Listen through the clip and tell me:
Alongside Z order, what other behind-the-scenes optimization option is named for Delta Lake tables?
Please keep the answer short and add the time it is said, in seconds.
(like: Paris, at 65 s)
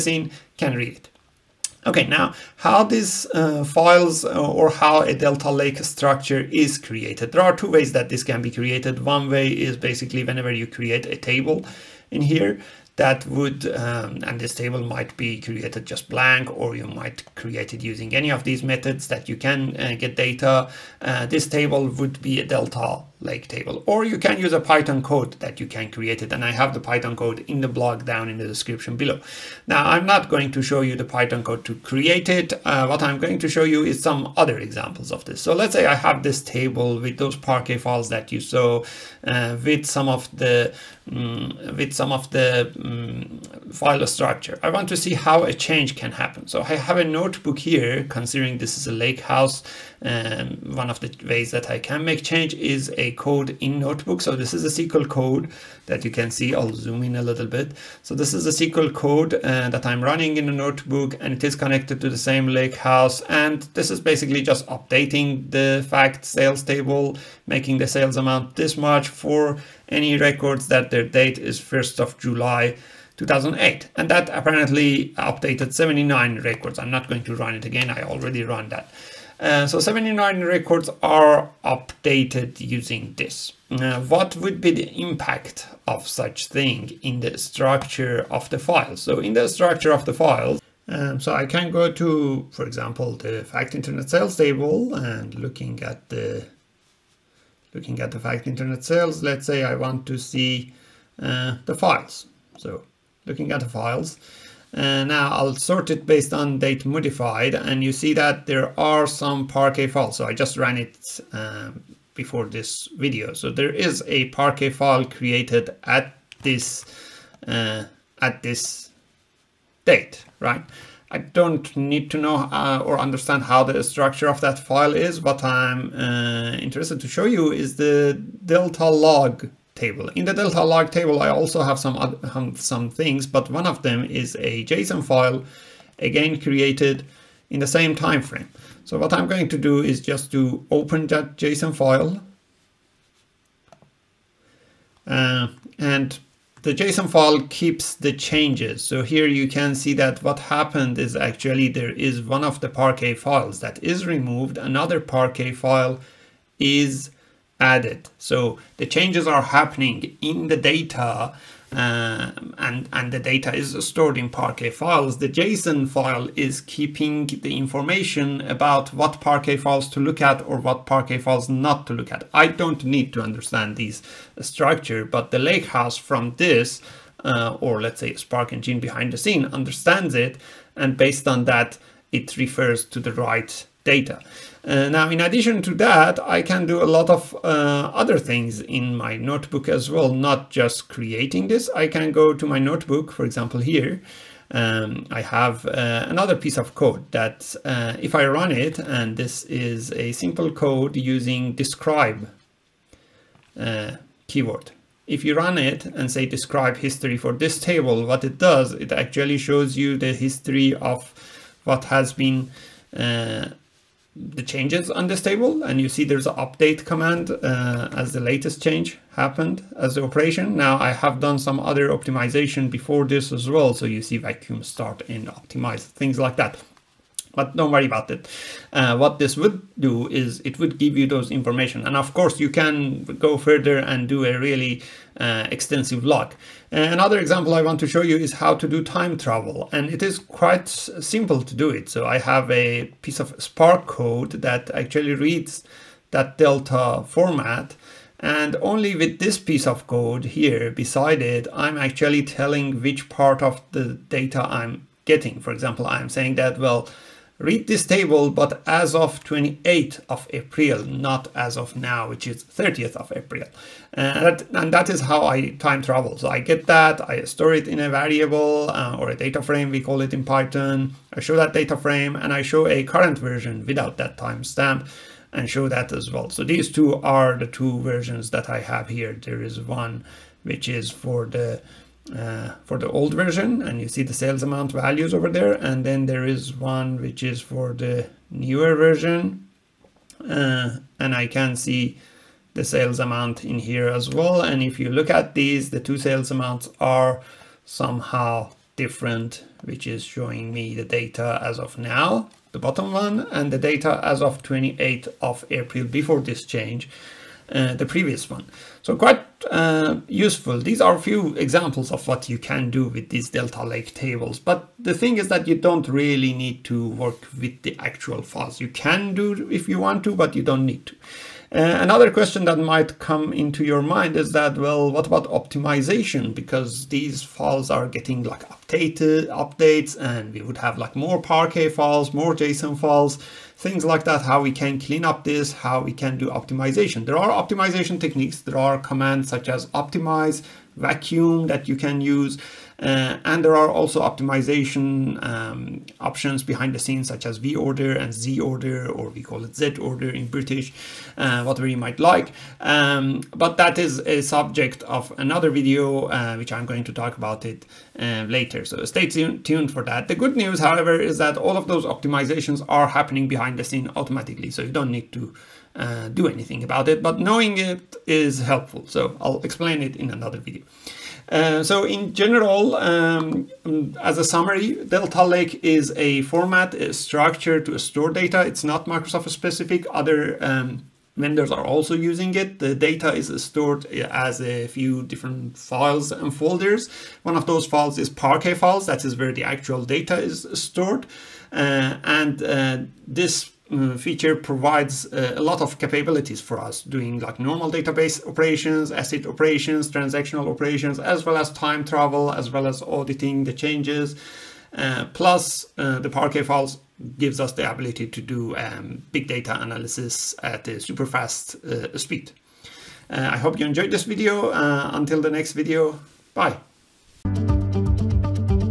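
V order, at 347 s.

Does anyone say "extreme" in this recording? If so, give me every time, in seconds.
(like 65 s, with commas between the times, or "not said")
not said.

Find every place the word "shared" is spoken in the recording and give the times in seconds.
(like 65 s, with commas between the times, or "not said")
not said.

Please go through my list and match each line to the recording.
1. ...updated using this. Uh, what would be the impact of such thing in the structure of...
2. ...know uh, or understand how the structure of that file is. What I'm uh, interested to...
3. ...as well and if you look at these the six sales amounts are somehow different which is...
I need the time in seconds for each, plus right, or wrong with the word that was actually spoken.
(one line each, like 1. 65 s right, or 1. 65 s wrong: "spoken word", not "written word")
1. 81 s right
2. 122 s right
3. 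293 s wrong: "two", not "six".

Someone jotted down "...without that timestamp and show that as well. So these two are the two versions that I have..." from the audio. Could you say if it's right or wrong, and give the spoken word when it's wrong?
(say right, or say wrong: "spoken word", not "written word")
right.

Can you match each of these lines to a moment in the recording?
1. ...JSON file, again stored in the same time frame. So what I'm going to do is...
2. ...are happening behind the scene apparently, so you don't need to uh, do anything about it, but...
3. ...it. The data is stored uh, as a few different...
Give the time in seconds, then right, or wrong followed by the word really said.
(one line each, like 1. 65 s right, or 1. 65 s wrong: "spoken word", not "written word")
1. 134 s wrong: "created", not "stored"
2. 362 s wrong: "automatically", not "apparently"
3. 382 s right.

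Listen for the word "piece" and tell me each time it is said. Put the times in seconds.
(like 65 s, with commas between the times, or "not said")
196 s, 243 s, 249 s.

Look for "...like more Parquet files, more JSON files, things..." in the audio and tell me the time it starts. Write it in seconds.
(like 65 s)
330 s.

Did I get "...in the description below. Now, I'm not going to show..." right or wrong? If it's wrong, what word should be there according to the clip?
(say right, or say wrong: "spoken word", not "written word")
right.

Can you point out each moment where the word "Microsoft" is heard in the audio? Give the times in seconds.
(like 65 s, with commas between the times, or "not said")
378 s.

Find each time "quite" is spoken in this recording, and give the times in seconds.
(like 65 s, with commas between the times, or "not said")
240 s, 308 s.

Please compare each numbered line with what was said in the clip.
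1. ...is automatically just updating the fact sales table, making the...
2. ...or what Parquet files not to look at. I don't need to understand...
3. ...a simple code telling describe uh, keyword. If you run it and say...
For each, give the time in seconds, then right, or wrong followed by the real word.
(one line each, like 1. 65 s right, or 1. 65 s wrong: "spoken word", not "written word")
1. 63 s wrong: "basically", not "automatically"
2. 170 s right
3. 199 s wrong: "using", not "telling".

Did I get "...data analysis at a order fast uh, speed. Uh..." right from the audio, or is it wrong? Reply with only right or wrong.
wrong.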